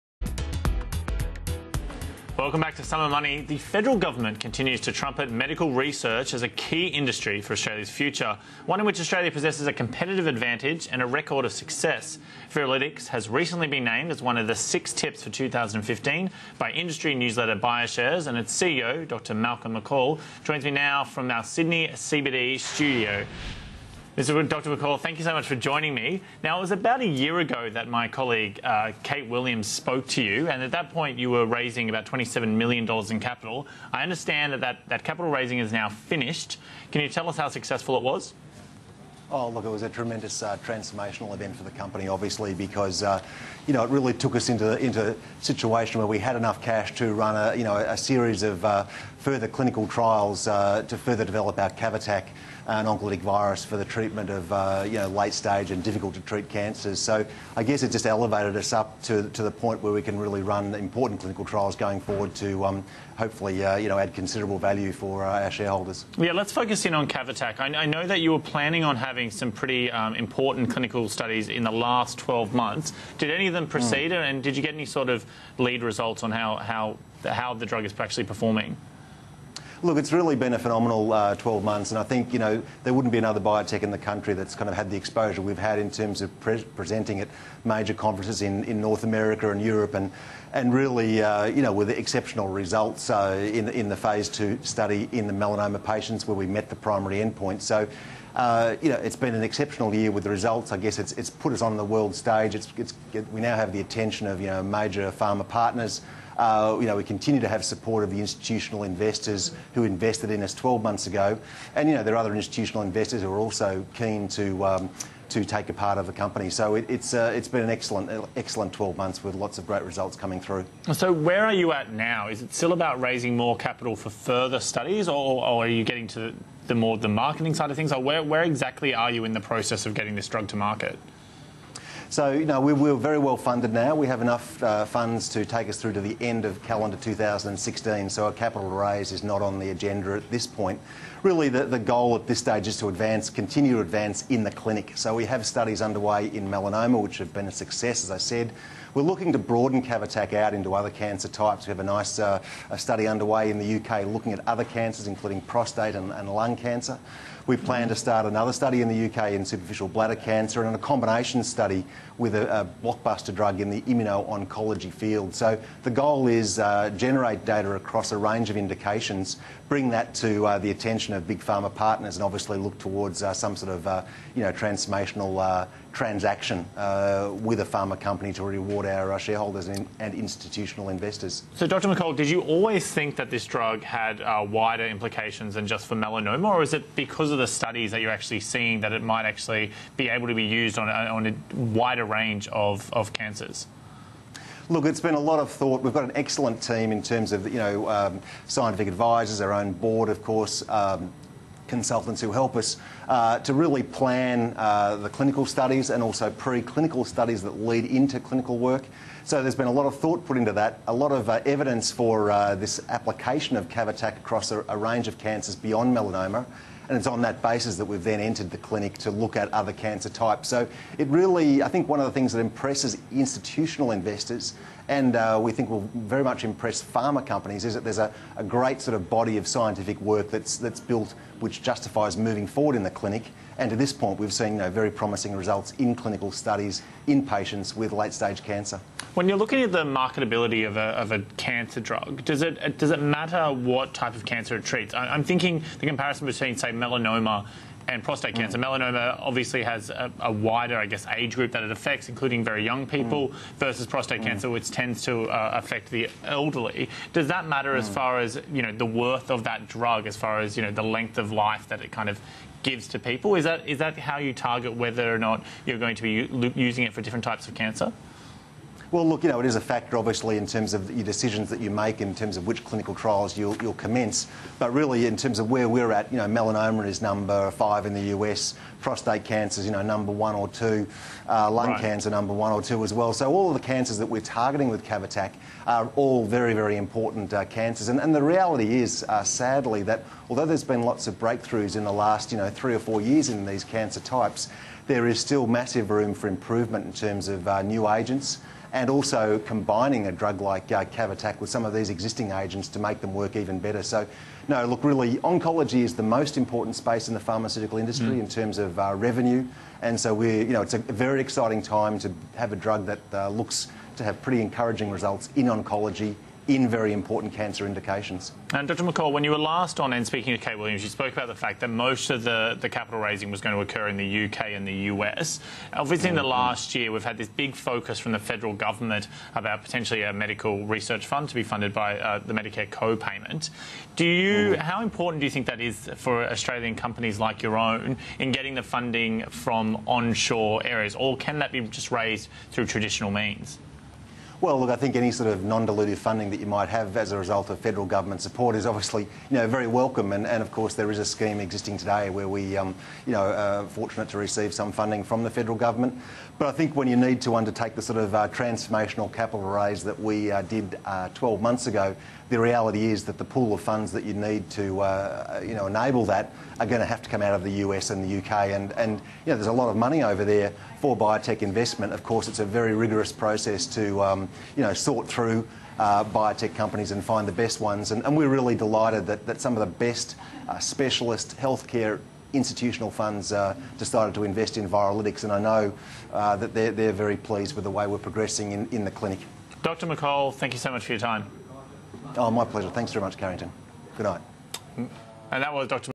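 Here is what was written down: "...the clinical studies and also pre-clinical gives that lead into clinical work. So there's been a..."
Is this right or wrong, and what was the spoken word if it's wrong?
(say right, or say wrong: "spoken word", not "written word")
wrong: "studies", not "gives".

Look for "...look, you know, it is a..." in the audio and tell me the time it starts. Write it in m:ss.
4:29.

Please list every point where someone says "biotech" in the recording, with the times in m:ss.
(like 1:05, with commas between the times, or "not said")
1:23, 6:10, 6:16.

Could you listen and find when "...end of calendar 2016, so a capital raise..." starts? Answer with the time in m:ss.
2:16.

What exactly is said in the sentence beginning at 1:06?
Yeah, let's focus in on CAVATAK.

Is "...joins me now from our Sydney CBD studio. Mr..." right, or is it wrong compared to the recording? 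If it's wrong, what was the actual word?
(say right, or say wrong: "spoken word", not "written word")
right.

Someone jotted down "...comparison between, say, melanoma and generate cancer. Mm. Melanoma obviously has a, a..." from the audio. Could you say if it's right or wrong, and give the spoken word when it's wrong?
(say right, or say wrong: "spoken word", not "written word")
wrong: "prostate", not "generate".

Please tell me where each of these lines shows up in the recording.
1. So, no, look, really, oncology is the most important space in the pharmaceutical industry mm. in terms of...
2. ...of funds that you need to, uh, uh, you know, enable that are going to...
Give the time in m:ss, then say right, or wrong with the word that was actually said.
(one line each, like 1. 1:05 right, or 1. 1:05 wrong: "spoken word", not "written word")
1. 5:03 right
2. 6:03 right.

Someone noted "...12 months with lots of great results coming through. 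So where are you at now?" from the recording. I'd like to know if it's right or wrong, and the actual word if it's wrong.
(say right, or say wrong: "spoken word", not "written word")
right.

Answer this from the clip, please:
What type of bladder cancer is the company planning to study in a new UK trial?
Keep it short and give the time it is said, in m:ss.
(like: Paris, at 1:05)
Superficial bladder cancer, at 2:39.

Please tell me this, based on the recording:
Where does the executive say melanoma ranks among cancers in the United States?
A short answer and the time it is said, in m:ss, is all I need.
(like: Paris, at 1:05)
Number 5, at 4:37.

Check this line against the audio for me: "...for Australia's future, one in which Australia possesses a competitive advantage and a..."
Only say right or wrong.
right.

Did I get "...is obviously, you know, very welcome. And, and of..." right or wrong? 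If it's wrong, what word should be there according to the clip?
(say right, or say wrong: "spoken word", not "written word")
right.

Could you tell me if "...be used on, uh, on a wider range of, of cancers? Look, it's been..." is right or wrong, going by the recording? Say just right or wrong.
right.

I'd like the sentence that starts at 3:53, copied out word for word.
And to this point, we've seen you know, very promising results in clinical studies in patients with late stage cancer.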